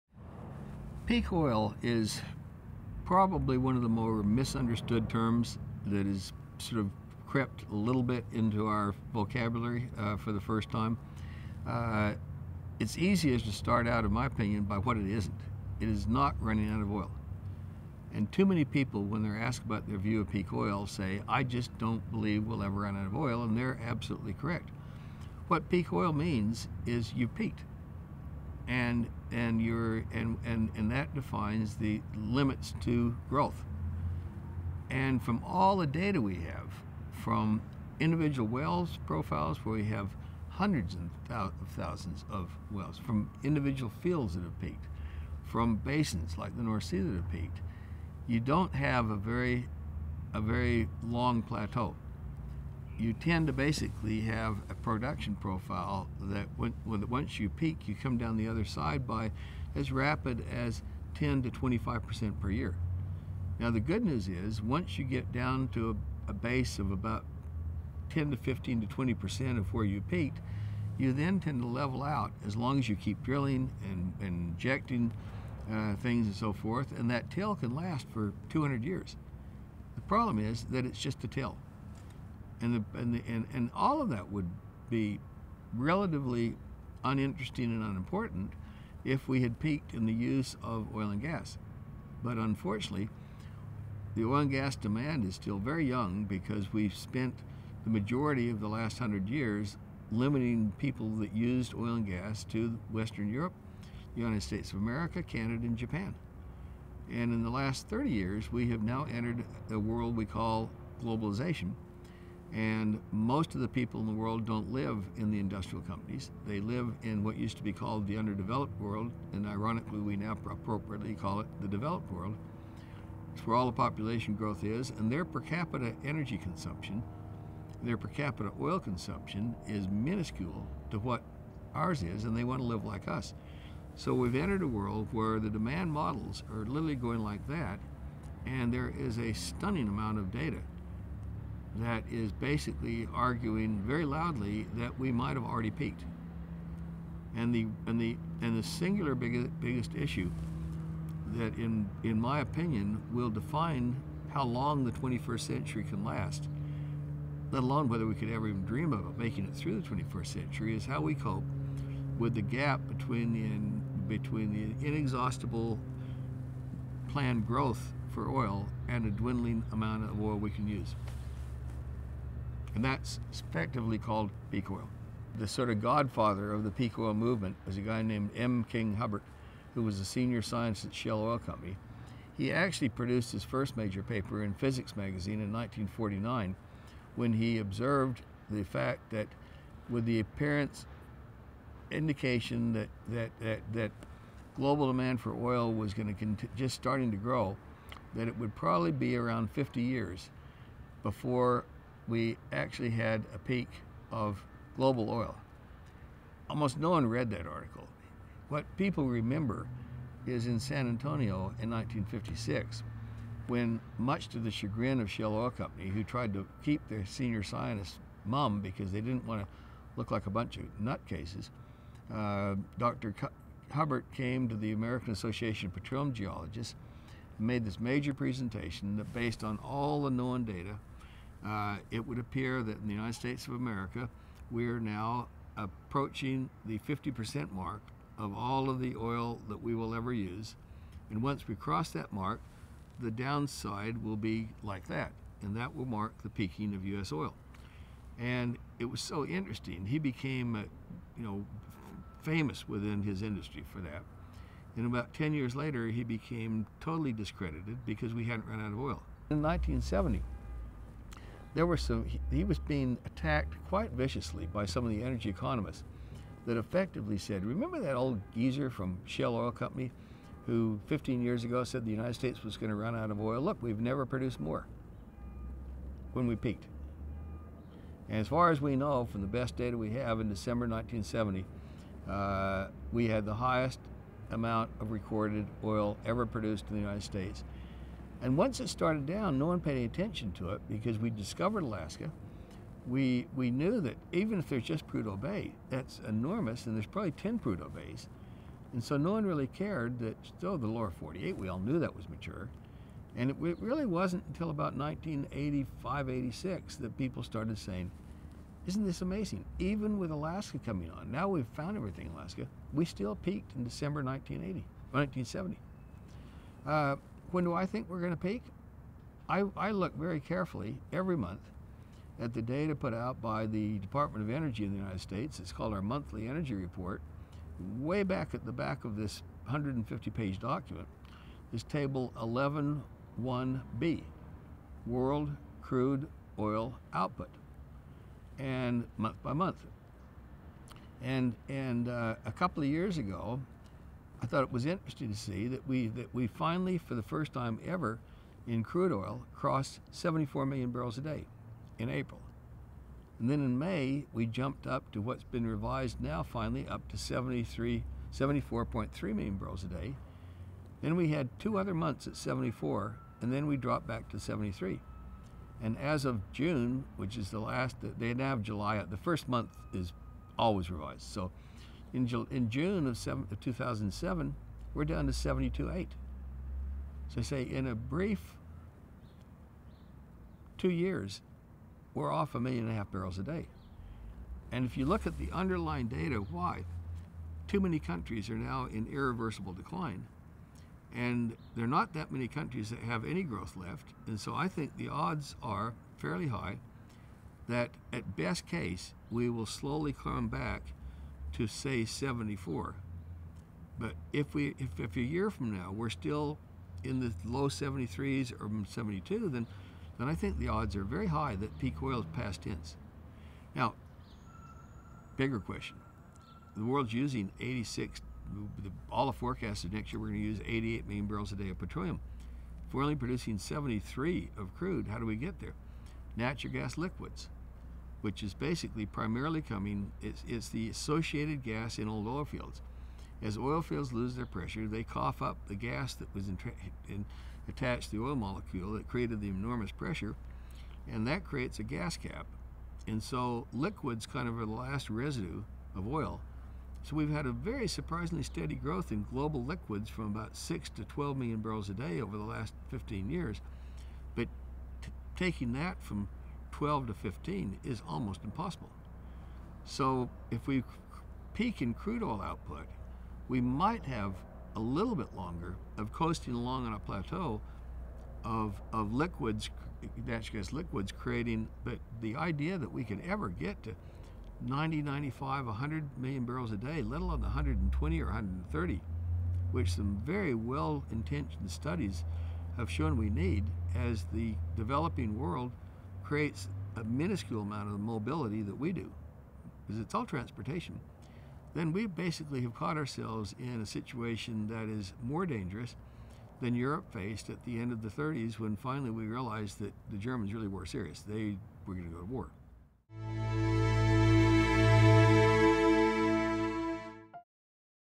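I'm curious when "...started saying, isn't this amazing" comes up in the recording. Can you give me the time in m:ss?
5:07.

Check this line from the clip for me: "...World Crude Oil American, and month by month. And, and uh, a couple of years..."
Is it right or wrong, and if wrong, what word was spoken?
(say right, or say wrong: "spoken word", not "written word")
wrong: "Output", not "American".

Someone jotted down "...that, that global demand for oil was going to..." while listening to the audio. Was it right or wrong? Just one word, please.
right.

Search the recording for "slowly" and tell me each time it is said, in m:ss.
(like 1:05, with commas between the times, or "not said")
6:39.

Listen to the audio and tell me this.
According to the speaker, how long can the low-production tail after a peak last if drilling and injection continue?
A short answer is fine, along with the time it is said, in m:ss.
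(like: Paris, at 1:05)
200 years, at 1:18.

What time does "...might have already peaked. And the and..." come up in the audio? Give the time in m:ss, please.
2:25.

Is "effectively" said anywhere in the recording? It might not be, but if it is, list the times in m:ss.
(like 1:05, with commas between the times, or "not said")
2:53, 4:26.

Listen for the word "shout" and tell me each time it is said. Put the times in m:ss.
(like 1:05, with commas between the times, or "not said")
not said.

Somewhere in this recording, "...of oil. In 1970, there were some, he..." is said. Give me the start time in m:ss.
4:18.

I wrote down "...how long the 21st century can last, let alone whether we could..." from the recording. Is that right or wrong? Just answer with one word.
right.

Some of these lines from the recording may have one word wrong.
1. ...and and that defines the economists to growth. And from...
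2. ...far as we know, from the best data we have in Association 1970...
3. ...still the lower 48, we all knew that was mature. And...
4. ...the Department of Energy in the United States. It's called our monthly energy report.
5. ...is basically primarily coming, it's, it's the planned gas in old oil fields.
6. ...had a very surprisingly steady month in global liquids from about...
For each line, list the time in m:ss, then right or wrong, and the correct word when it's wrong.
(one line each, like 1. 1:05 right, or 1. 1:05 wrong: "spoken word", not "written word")
1. 0:30 wrong: "limits", not "economists"
2. 4:38 wrong: "December", not "Association"
3. 5:00 right
4. 5:23 right
5. 7:08 wrong: "associated", not "planned"
6. 7:27 wrong: "growth", not "month".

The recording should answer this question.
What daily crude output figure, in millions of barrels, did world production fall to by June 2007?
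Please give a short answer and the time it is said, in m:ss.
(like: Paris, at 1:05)
72.8 million, at 6:15.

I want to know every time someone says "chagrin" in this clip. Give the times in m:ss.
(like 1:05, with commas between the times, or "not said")
3:34.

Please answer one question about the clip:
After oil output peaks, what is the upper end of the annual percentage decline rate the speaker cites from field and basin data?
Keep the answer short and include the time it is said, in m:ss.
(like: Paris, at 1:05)
25%, at 1:01.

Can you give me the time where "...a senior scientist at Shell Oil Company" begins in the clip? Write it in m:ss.
2:59.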